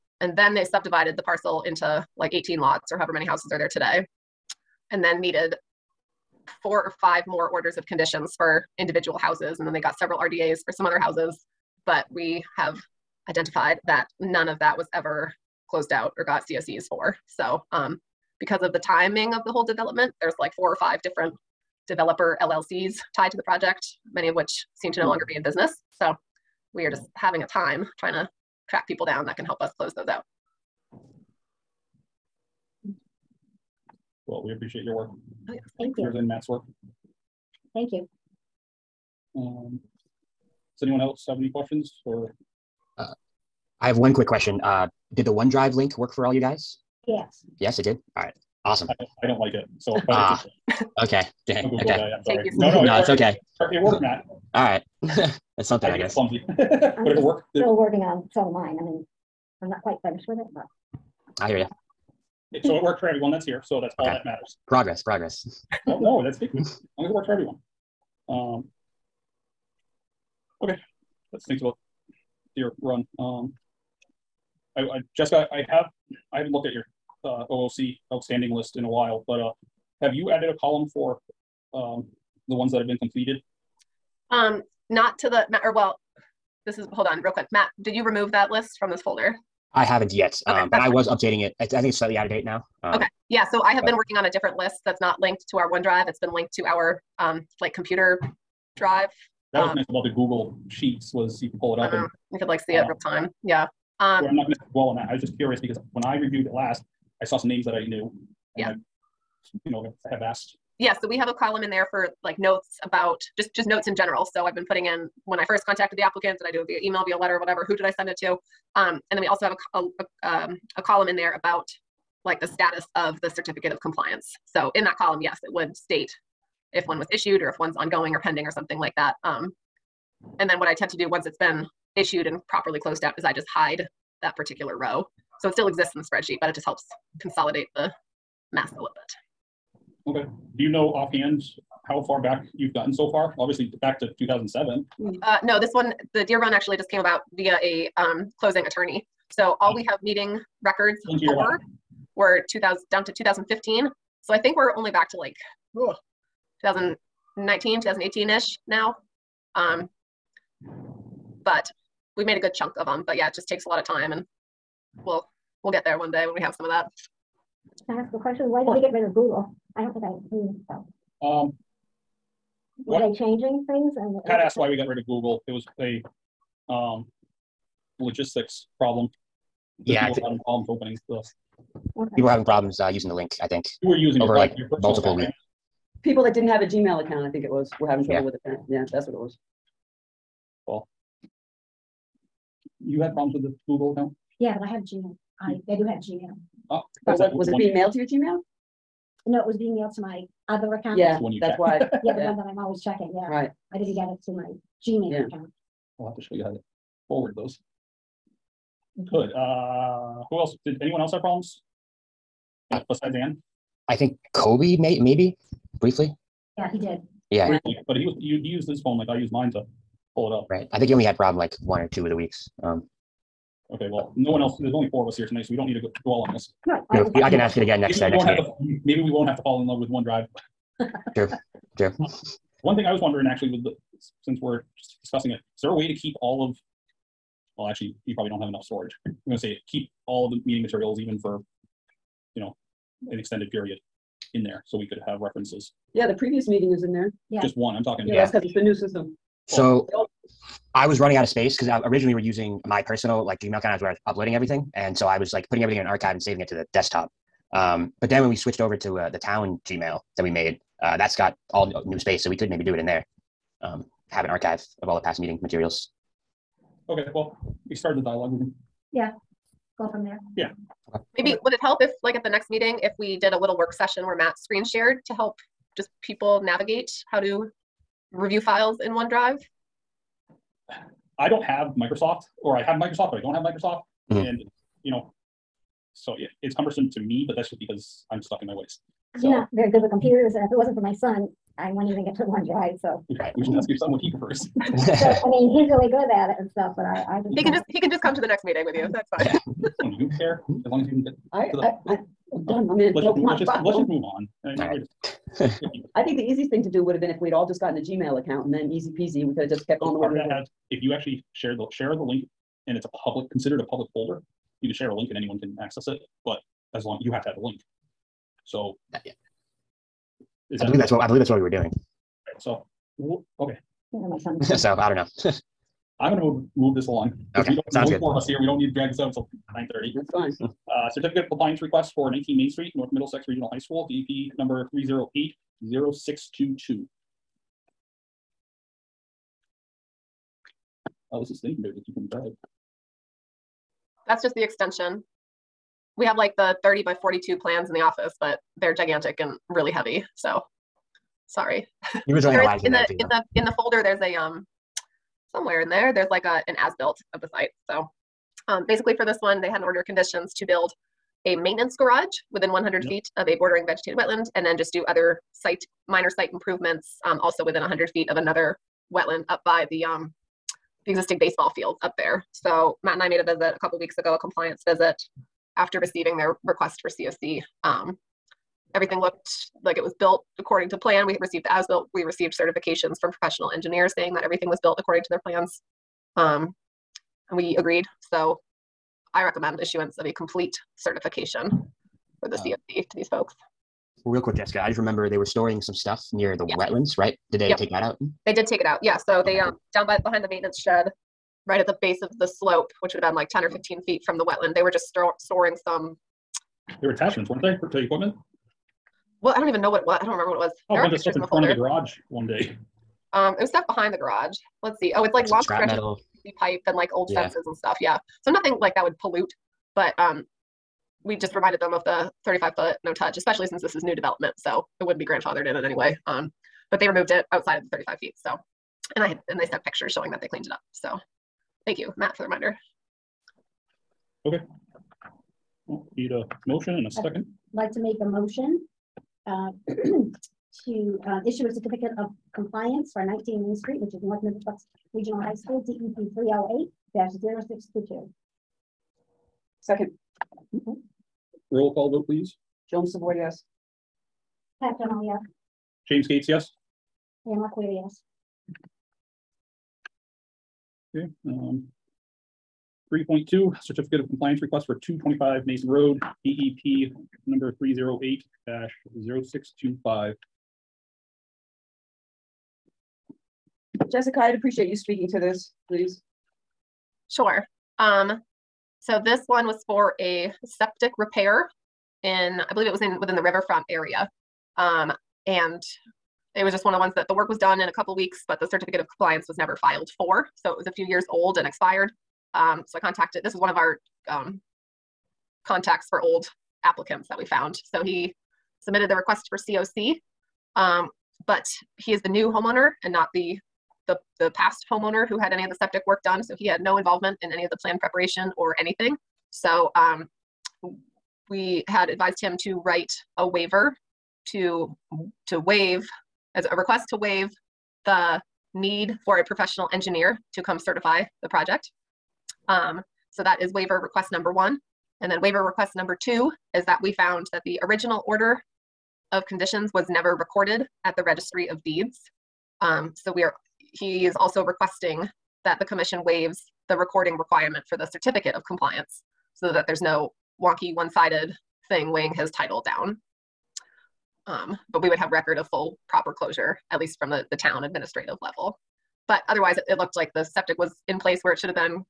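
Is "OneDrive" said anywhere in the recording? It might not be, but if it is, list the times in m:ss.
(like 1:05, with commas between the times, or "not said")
0:45, 1:35, 3:49, 4:38.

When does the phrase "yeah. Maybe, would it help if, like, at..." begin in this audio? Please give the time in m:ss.
4:30.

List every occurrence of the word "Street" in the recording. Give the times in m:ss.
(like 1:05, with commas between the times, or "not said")
5:32, 7:23.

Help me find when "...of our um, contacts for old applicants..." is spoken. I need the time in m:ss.
8:13.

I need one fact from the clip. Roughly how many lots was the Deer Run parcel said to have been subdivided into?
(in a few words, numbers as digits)
18.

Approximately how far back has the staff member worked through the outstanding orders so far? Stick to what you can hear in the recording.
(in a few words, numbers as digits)
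2018.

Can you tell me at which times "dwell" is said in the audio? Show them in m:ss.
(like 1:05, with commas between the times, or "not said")
1:44, 3:46.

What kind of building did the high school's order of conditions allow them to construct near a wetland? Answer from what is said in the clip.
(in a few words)
Maintenance garage.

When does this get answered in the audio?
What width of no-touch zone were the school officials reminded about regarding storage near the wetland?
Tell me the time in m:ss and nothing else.
7:02.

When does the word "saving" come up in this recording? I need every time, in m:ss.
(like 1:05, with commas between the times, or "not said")
4:16.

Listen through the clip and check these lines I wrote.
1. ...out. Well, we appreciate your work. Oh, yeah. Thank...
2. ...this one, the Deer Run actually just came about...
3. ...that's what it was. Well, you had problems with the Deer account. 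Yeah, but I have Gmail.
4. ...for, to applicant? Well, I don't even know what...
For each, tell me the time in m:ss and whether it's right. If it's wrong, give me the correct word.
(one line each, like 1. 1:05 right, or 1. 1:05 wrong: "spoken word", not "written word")
1. 0:30 right
2. 2:25 right
3. 3:08 wrong: "Google", not "Deer"
4. 6:47 wrong: "equipment", not "applicant".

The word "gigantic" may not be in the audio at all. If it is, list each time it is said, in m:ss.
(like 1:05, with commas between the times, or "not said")
5:48.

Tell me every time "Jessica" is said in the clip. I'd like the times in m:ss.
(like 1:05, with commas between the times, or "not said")
1:15, 6:34, 7:53.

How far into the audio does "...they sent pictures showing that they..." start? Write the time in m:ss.
7:09.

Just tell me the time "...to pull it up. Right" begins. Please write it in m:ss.
3:39.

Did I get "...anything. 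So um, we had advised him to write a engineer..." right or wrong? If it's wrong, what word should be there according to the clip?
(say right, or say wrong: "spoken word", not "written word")
wrong: "waiver", not "engineer".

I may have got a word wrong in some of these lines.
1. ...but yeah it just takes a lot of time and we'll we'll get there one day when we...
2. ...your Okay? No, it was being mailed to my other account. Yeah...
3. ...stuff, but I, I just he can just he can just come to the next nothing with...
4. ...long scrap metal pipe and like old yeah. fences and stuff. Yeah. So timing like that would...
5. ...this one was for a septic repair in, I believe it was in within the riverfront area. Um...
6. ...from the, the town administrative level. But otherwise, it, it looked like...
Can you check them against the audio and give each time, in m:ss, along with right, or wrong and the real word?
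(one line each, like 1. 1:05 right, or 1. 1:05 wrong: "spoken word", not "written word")
1. 2:43 right
2. 3:17 wrong: "Gmail", not "Okay"
3. 4:56 wrong: "meeting", not "nothing"
4. 6:55 wrong: "nothing", not "timing"
5. 7:59 right
6. 9:06 right.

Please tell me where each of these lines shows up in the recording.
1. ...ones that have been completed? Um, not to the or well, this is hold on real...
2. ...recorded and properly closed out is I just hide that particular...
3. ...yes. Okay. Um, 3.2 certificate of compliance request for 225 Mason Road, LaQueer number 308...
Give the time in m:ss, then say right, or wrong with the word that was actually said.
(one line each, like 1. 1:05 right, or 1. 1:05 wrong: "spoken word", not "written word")
1. 1:22 right
2. 2:11 wrong: "issued", not "recorded"
3. 7:37 wrong: "DEP", not "LaQueer".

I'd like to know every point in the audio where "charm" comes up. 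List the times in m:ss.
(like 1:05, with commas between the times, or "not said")
not said.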